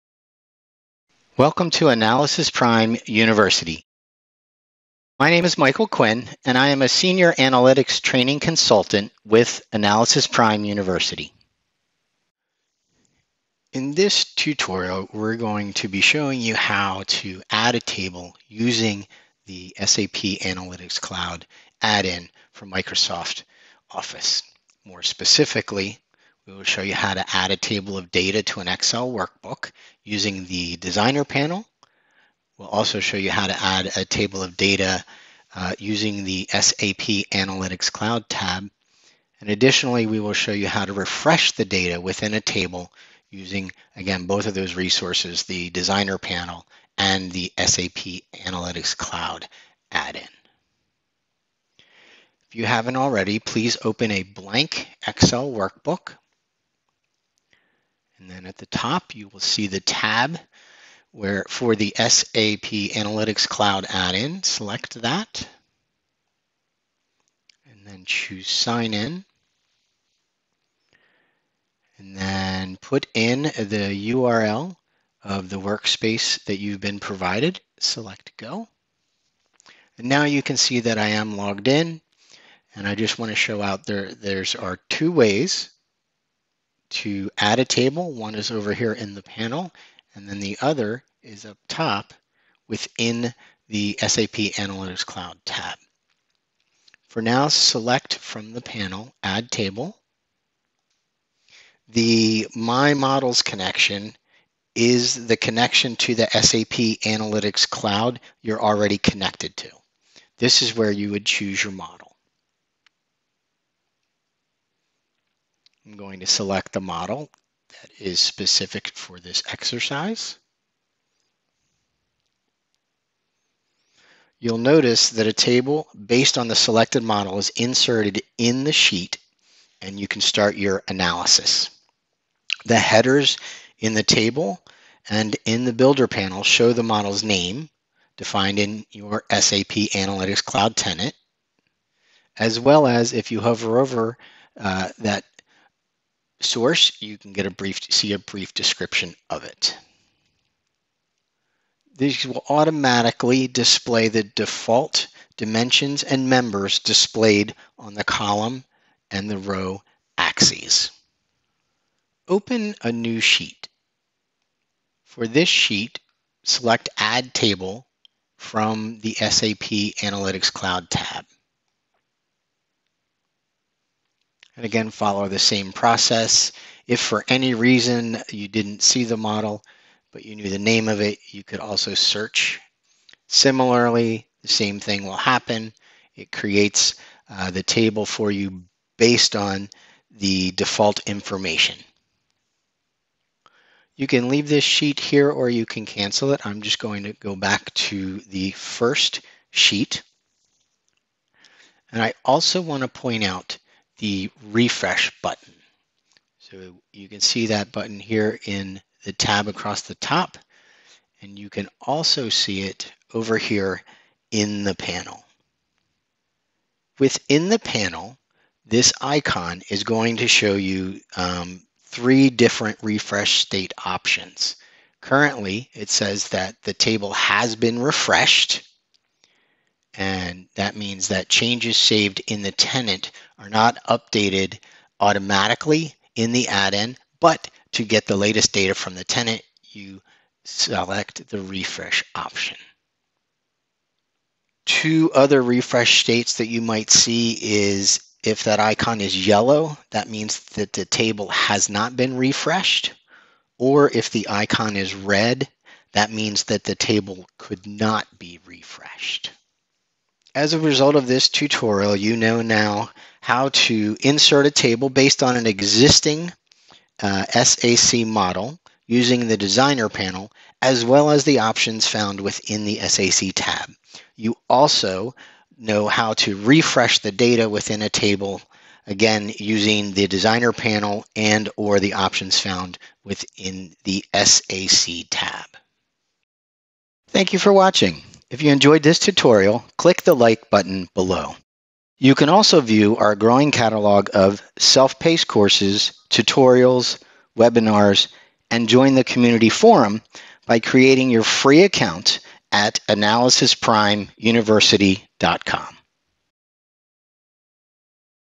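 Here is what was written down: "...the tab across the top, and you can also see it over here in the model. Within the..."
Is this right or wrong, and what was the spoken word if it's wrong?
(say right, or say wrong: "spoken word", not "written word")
wrong: "panel", not "model".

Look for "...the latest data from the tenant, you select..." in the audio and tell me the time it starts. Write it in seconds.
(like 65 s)
238 s.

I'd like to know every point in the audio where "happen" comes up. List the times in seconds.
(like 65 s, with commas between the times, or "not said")
185 s.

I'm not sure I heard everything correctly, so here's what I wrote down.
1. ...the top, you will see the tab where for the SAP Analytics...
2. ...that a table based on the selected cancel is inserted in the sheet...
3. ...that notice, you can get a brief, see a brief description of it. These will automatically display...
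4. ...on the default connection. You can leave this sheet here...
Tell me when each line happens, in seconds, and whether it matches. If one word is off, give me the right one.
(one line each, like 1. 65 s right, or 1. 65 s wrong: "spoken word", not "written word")
1. 58 s right
2. 125 s wrong: "model", not "cancel"
3. 144 s wrong: "source", not "notice"
4. 189 s wrong: "information", not "connection".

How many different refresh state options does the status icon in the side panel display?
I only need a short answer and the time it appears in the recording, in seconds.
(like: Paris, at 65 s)
3, at 221 s.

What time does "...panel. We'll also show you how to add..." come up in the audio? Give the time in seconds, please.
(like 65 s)
31 s.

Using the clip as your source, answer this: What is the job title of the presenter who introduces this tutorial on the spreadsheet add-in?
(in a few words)
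Senior Analytics Training Consultant.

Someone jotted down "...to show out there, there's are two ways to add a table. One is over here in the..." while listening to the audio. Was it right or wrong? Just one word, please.
right.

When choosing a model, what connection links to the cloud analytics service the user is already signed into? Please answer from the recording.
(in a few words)
My Models.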